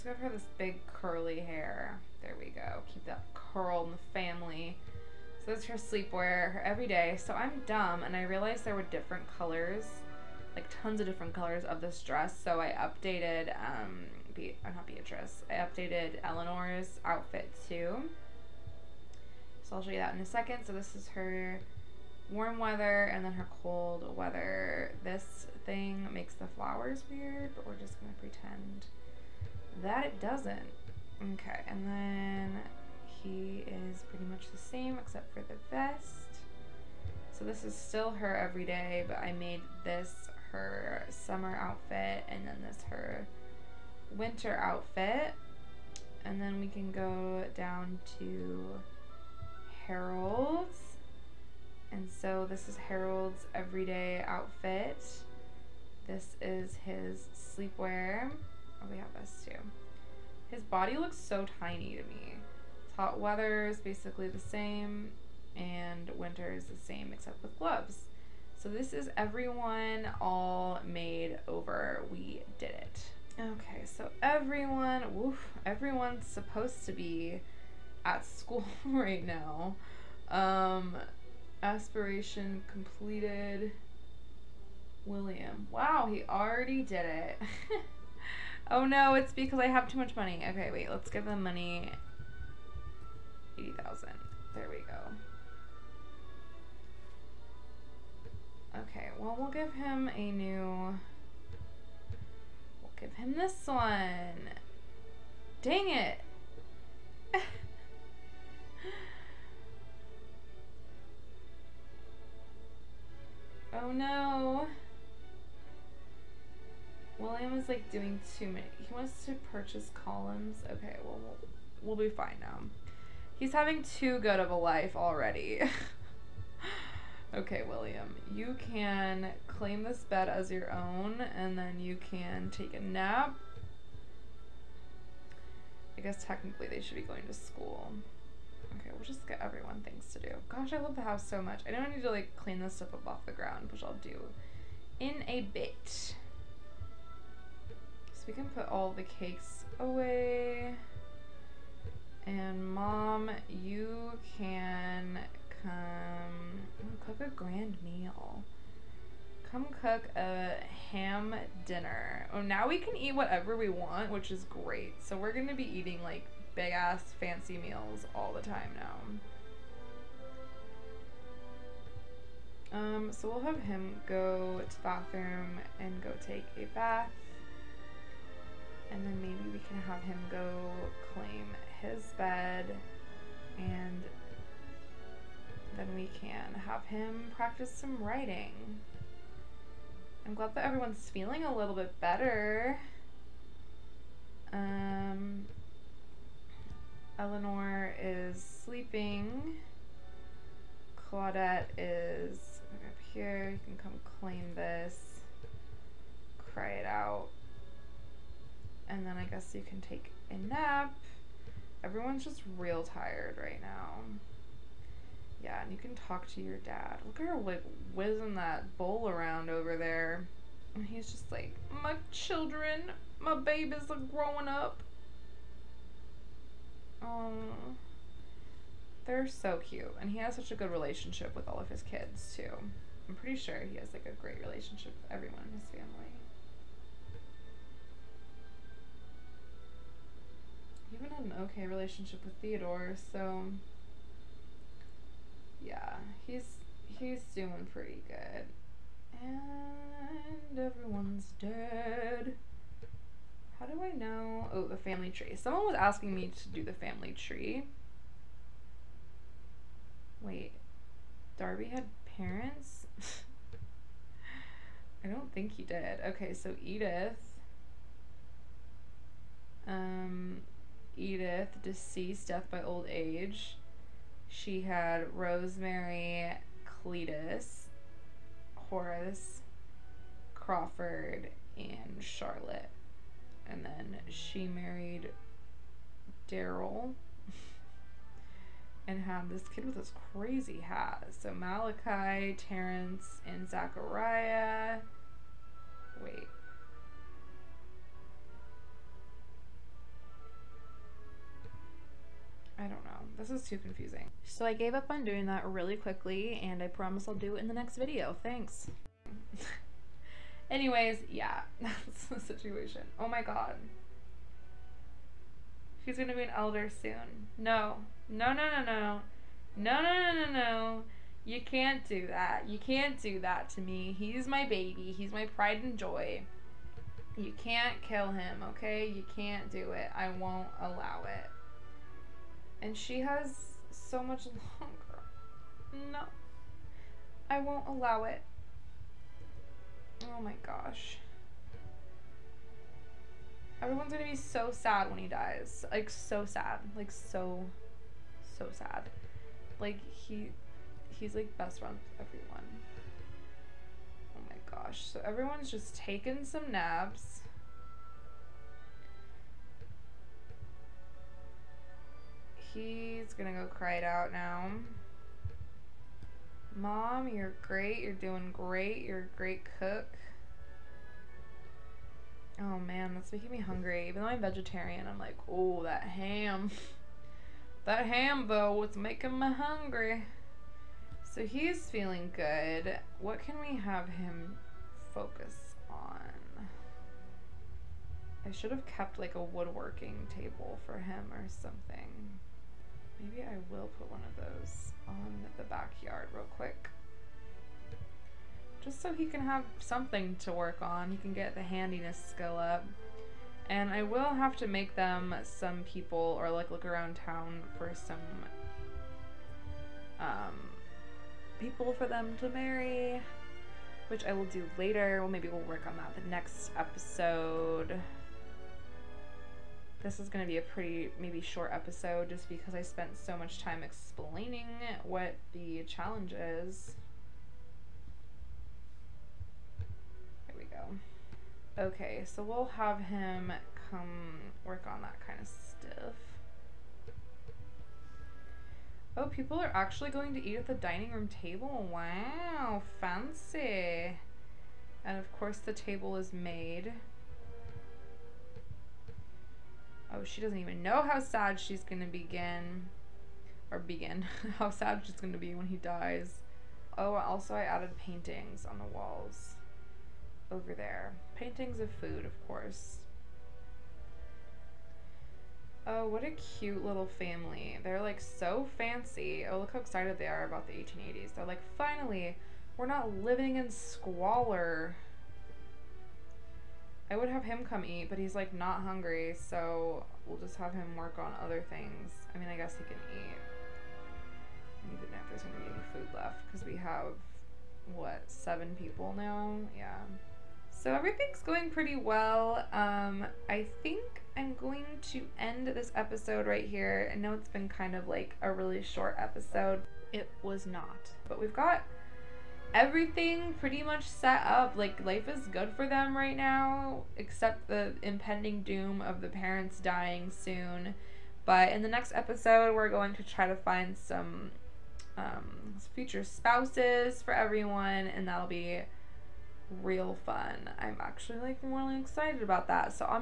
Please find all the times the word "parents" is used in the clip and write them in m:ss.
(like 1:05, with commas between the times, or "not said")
4:22, 8:29.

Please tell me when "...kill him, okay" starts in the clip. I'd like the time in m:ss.
5:27.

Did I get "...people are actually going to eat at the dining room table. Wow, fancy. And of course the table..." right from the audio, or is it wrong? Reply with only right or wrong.
right.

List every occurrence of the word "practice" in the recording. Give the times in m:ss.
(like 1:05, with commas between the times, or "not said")
3:07.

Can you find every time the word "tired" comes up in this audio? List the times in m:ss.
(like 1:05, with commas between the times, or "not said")
3:32.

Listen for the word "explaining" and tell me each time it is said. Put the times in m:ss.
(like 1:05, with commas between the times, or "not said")
7:03.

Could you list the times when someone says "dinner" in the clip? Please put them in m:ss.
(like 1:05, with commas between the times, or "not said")
2:41.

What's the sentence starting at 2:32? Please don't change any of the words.
And mom, you can come cook a grand meal.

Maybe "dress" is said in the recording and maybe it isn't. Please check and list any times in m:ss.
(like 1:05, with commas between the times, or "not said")
0:12.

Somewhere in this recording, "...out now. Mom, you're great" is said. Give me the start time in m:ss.
6:03.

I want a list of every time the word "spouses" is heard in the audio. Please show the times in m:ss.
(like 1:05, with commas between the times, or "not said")
8:36.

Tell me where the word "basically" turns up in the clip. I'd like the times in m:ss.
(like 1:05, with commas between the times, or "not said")
1:03.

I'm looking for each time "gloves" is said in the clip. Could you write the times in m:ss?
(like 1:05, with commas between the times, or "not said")
1:07.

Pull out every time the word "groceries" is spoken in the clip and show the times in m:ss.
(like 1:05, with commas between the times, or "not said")
not said.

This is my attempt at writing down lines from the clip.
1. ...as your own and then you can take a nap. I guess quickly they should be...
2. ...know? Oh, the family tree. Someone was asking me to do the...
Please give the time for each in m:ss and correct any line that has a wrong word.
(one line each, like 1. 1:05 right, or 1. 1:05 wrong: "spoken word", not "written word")
1. 2:10 wrong: "technically", not "quickly"
2. 4:13 right.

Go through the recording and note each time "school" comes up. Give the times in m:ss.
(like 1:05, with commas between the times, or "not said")
1:18, 2:17.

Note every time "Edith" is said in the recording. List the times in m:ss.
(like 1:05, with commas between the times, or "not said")
4:26, 4:31.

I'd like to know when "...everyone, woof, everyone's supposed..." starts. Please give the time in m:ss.
1:14.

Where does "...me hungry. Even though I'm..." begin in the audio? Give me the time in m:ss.
6:13.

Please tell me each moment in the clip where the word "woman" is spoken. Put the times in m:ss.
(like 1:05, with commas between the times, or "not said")
not said.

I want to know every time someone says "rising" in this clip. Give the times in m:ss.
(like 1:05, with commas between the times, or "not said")
not said.